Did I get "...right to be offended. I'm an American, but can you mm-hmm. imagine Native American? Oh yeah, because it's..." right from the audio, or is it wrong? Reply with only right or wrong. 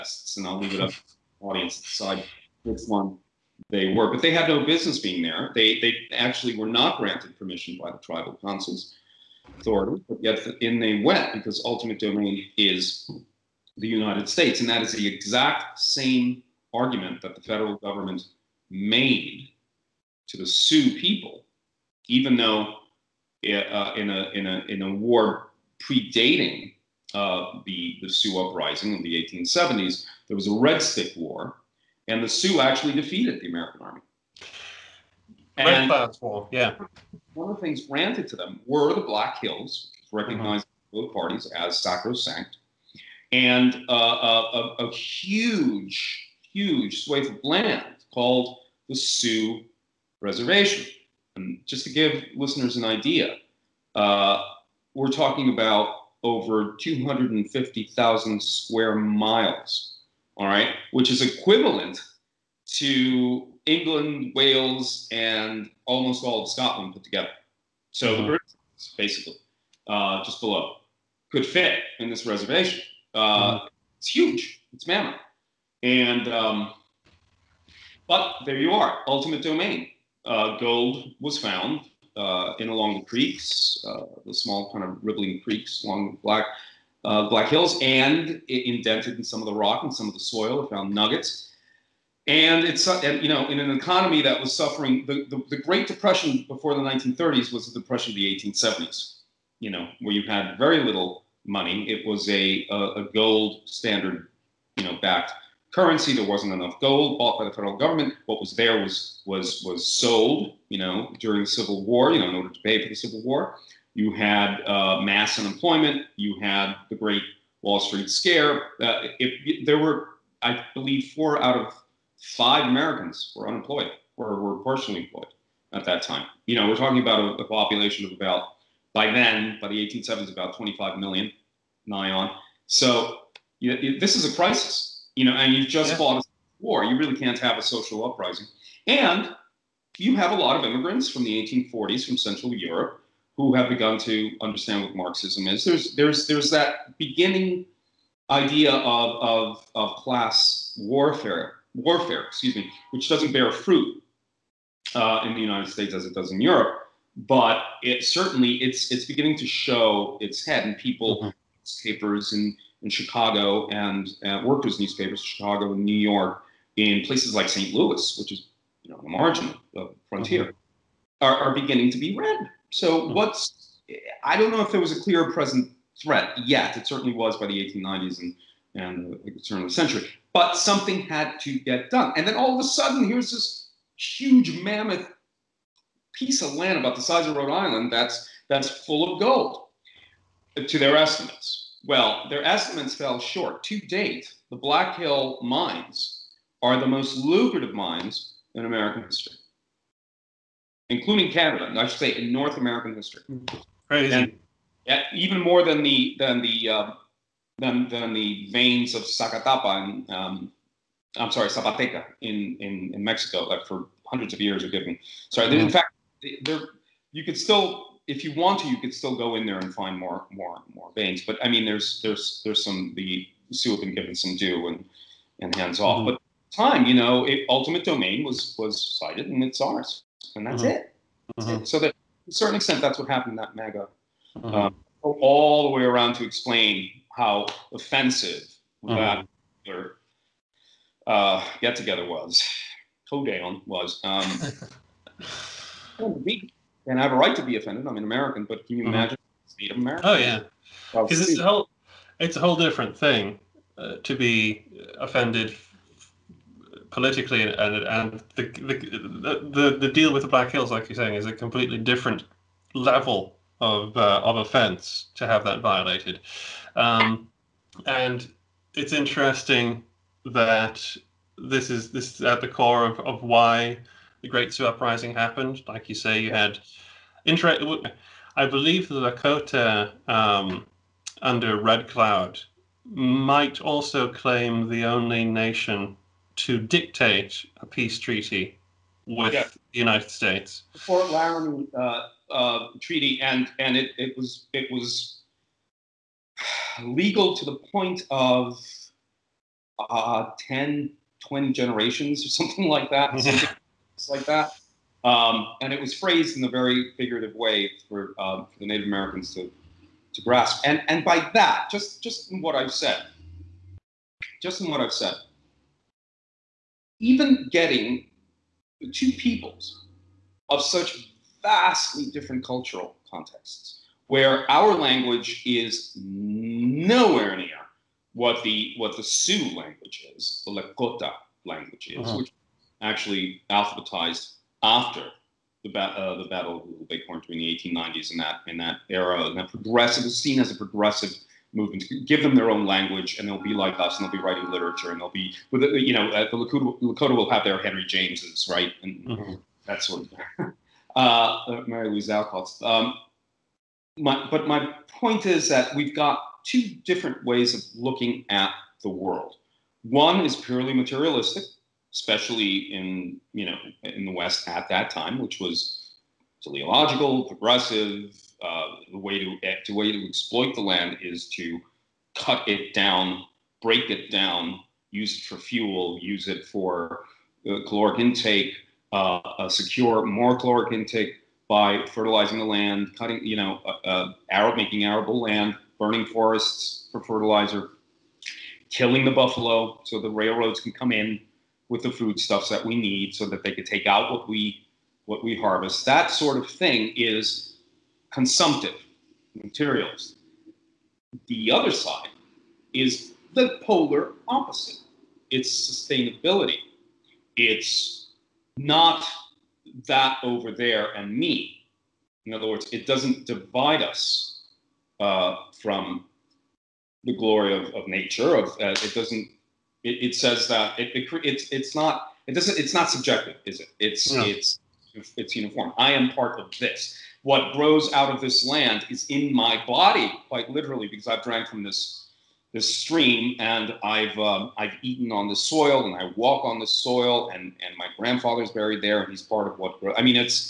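right.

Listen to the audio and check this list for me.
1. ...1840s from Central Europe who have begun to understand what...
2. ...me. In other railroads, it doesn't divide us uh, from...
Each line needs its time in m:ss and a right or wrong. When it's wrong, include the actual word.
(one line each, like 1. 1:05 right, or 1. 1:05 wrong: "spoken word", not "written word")
1. 2:21 right
2. 6:51 wrong: "words", not "railroads".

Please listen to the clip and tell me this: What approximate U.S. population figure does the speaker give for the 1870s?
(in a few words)
25 million.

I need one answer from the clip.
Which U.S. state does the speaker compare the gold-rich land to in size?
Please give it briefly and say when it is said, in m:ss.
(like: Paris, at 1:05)
Rhode Island, at 3:07.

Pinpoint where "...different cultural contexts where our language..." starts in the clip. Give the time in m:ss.
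5:22.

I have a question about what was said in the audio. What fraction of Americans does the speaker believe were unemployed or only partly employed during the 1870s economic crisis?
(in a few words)
four out of five.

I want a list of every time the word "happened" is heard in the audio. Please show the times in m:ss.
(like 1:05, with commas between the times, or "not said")
3:53, 4:35.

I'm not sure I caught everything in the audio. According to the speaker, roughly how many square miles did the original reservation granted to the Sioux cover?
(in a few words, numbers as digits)
250,000.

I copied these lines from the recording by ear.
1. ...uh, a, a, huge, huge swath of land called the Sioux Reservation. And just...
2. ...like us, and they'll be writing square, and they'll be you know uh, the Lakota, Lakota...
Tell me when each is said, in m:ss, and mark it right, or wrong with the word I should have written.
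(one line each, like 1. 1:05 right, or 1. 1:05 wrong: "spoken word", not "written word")
1. 0:44 right
2. 5:43 wrong: "literature", not "square".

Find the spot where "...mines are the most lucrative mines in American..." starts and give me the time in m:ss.
3:15.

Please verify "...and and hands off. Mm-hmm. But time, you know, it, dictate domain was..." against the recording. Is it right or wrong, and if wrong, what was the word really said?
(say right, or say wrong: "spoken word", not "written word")
wrong: "ultimate", not "dictate".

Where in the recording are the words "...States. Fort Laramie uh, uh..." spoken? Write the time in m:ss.
4:50.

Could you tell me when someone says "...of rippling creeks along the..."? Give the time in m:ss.
1:24.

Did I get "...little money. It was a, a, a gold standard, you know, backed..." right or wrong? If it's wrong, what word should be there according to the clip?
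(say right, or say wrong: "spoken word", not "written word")
right.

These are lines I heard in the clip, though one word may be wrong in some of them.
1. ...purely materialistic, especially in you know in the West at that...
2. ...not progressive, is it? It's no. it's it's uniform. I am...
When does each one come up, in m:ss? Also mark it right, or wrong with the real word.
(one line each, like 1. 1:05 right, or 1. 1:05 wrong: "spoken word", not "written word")
1. 6:00 right
2. 7:02 wrong: "subjective", not "progressive".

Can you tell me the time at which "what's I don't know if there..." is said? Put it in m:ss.
2:53.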